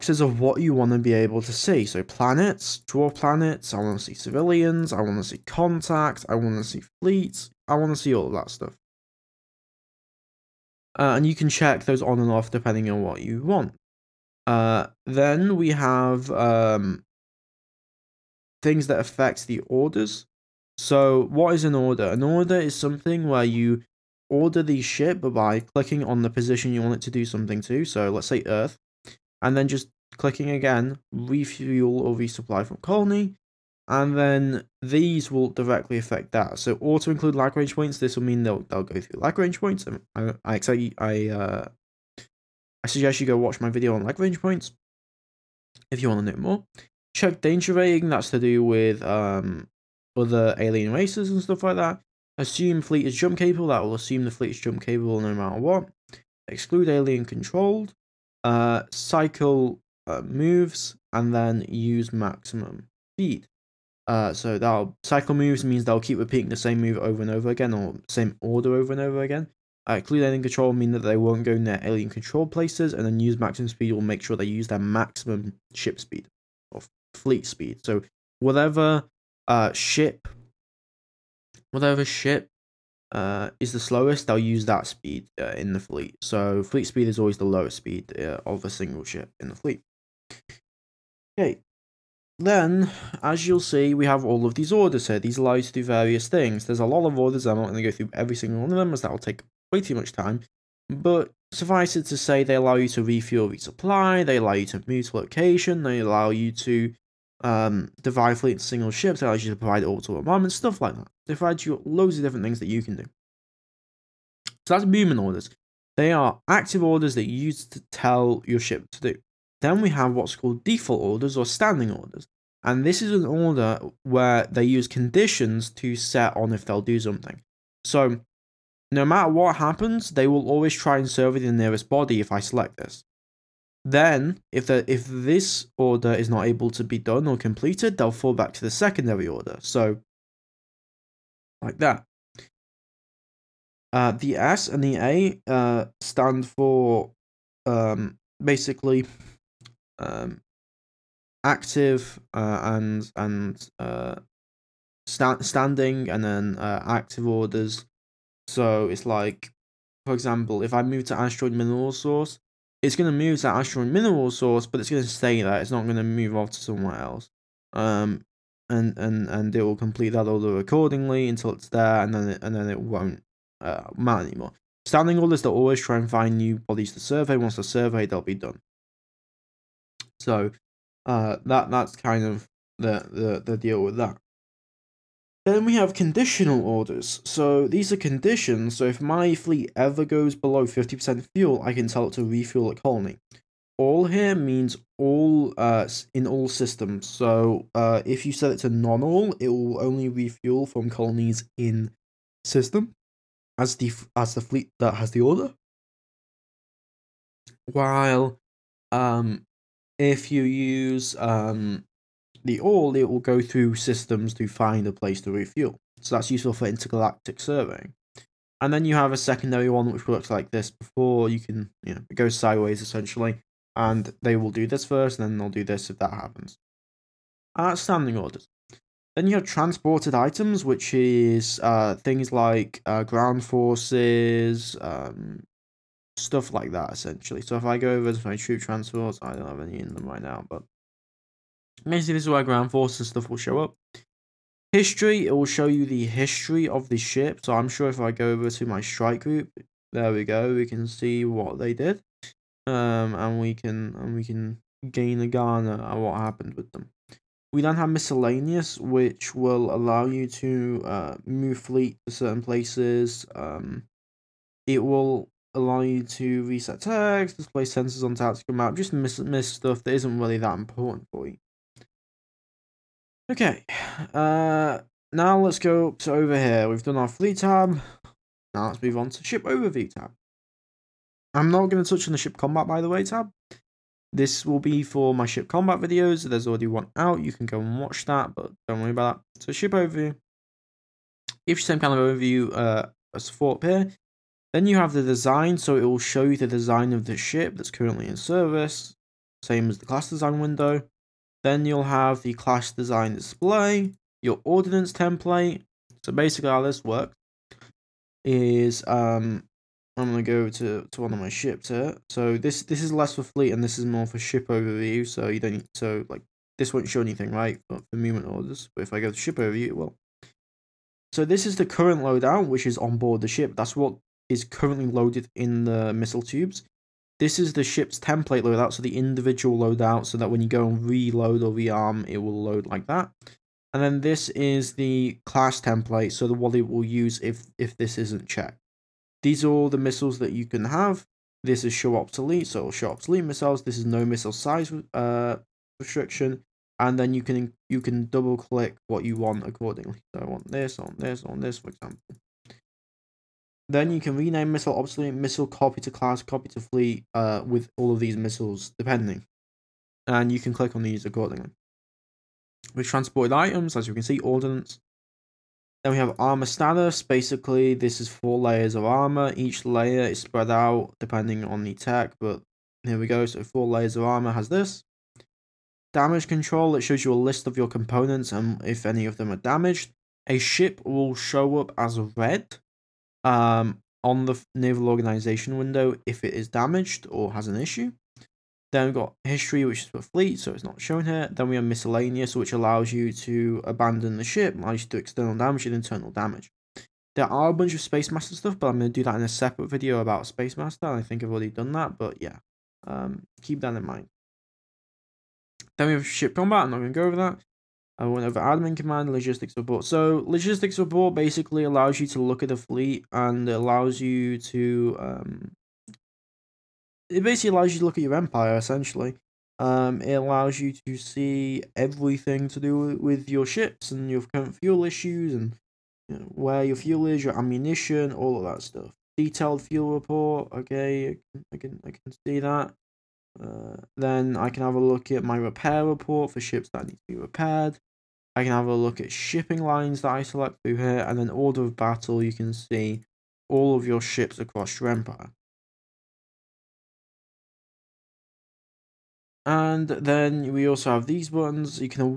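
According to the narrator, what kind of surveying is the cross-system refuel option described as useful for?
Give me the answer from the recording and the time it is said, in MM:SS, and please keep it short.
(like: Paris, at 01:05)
Intergalactic surveying, at 03:36.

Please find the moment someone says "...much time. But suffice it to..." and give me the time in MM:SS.
01:39.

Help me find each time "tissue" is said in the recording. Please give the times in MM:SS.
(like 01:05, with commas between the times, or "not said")
not said.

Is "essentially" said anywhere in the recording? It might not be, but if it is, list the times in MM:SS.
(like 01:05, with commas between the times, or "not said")
03:42, 03:56, 06:58.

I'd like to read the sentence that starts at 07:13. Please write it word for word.
Uh, then I can have a look at my repair report for ships that need to be repaired.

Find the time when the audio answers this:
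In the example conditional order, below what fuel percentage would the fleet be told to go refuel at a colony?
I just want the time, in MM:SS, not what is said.
03:10.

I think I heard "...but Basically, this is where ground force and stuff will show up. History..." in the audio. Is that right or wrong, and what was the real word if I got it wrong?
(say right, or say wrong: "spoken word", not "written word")
right.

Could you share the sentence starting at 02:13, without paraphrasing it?
Then, if the if this order is not able to be done or completed, they'll fall back to the secondary order.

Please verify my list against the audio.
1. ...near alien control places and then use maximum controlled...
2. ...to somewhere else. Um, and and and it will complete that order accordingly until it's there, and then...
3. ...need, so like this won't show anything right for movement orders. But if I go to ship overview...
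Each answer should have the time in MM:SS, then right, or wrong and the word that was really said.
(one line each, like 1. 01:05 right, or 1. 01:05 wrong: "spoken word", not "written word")
1. 01:11 wrong: "speed", not "controlled"
2. 02:46 right
3. 05:15 right.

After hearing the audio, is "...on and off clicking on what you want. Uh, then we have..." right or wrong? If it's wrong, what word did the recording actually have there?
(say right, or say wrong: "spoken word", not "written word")
wrong: "depending", not "clicking".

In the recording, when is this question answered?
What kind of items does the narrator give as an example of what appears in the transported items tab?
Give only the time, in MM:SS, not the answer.
03:53.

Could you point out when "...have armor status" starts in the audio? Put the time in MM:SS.
06:05.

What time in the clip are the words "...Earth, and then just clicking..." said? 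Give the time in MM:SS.
00:28.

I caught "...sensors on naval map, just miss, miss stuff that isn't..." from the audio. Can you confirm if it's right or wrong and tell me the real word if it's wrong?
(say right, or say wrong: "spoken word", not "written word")
wrong: "tactical", not "naval".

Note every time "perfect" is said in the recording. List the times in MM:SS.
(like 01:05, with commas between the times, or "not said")
not said.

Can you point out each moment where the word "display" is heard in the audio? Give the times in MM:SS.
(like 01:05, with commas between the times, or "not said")
04:27, 05:03.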